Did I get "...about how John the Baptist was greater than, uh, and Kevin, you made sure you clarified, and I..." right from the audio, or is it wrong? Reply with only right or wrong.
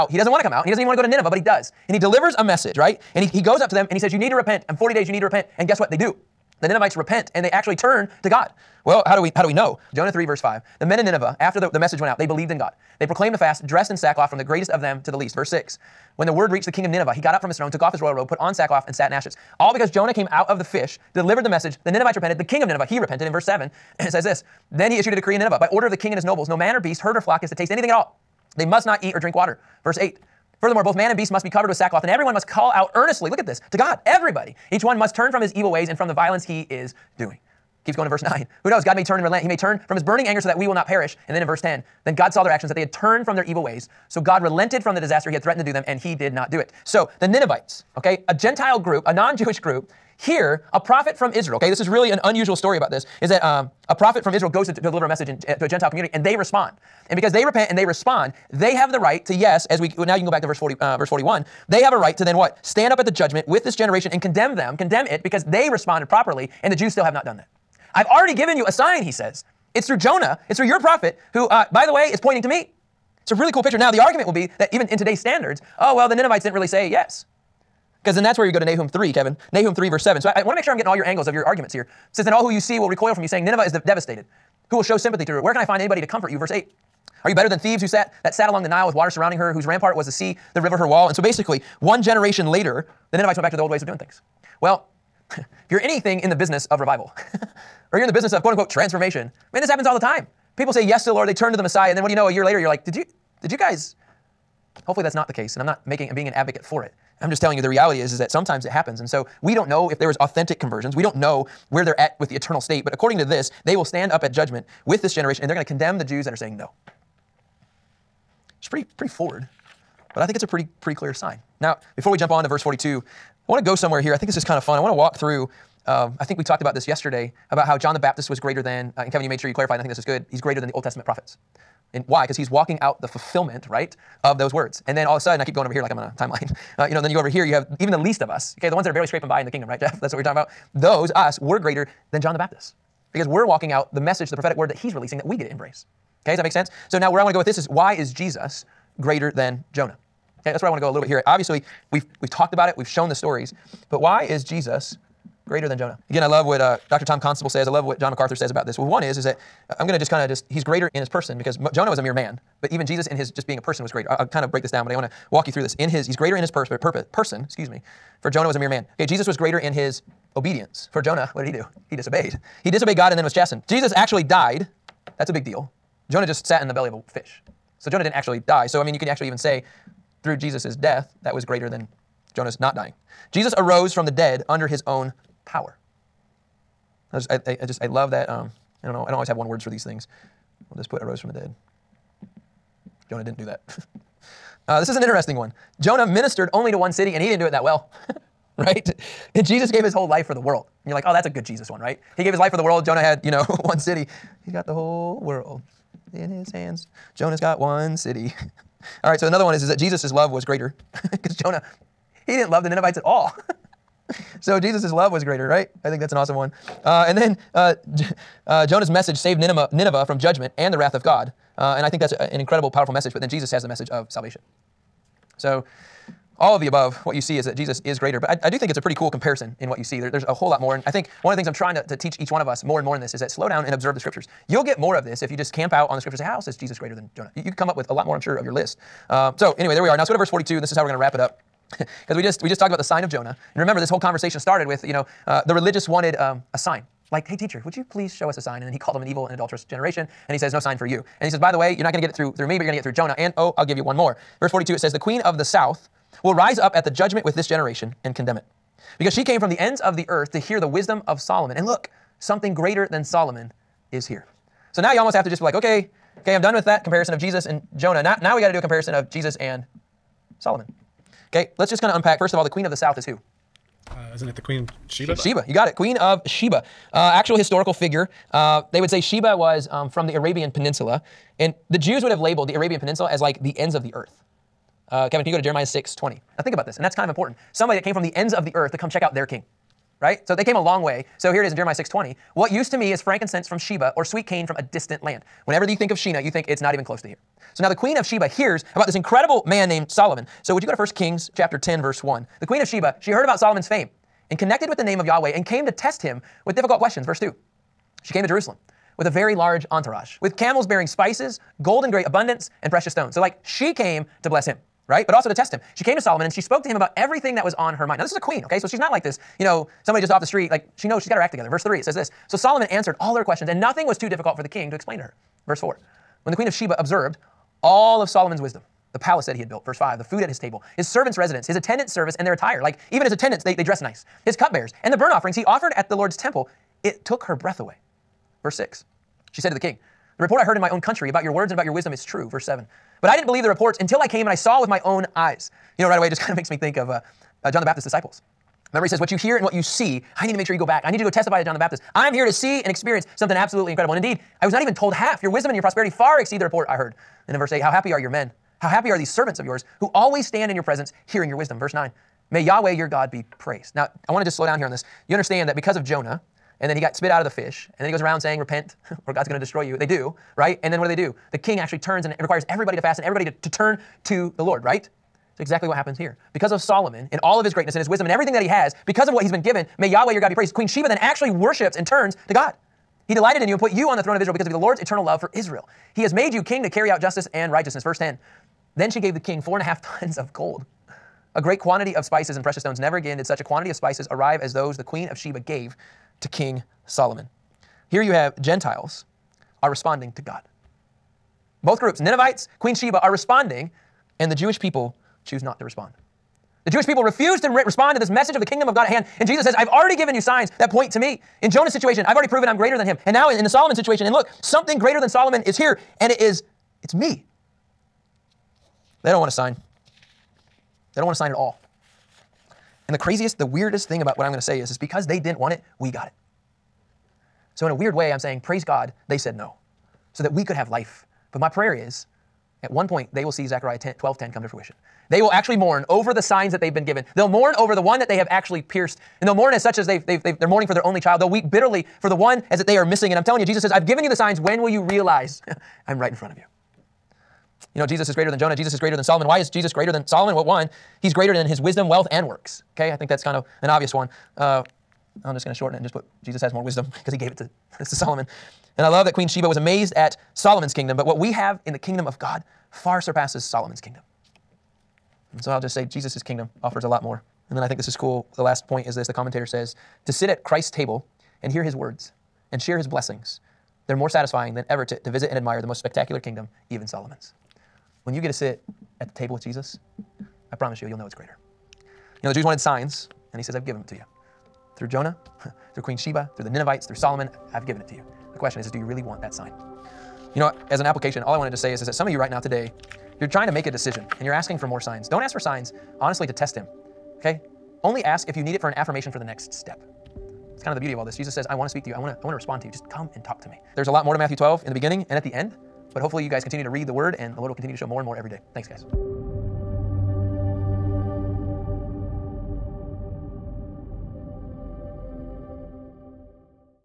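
right.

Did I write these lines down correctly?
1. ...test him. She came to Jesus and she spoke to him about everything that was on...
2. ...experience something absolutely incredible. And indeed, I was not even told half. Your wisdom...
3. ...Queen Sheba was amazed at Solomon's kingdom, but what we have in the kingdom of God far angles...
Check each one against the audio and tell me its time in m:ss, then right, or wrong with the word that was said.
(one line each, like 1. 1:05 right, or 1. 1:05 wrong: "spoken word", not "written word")
1. 5:15 wrong: "Solomon", not "Jesus"
2. 5:52 right
3. 7:39 wrong: "surpasses", not "angles".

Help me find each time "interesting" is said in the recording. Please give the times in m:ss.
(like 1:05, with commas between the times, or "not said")
3:15.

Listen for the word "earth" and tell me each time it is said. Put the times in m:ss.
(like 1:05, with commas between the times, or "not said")
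4:20, 4:43, 4:48.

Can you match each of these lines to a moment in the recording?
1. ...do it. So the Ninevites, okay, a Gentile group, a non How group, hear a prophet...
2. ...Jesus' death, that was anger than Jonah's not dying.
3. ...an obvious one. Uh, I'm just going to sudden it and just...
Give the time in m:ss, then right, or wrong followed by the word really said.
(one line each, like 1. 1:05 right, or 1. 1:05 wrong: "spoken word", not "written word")
1. 0:46 wrong: "Jewish", not "How"
2. 3:00 wrong: "greater", not "anger"
3. 7:33 wrong: "shorten", not "sudden".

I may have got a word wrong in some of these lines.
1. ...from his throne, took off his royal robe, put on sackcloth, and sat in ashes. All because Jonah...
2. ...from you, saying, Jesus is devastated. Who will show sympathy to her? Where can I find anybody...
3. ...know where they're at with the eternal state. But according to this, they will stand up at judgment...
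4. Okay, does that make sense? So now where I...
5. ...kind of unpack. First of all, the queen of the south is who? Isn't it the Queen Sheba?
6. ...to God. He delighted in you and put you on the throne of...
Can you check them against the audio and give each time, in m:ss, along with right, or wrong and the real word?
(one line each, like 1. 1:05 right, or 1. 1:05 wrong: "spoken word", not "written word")
1. 0:17 right
2. 1:23 wrong: "Nineveh", not "Jesus"
3. 1:51 right
4. 2:26 right
5. 4:31 right
6. 6:22 right.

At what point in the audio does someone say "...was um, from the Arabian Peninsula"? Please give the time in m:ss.
4:39.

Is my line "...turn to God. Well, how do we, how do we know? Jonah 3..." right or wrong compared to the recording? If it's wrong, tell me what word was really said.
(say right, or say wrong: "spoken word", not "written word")
right.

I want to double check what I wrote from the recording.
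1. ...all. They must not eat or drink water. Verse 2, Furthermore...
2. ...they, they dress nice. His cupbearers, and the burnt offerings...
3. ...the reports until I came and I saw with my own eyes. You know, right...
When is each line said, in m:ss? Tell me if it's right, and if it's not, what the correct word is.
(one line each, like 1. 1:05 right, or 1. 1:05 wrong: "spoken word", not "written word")
1. 0:27 wrong: "8", not "2"
2. 5:33 right
3. 5:43 right.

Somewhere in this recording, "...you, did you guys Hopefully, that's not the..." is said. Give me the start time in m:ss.
1:42.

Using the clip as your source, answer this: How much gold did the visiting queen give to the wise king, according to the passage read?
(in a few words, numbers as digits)
4.5 tons.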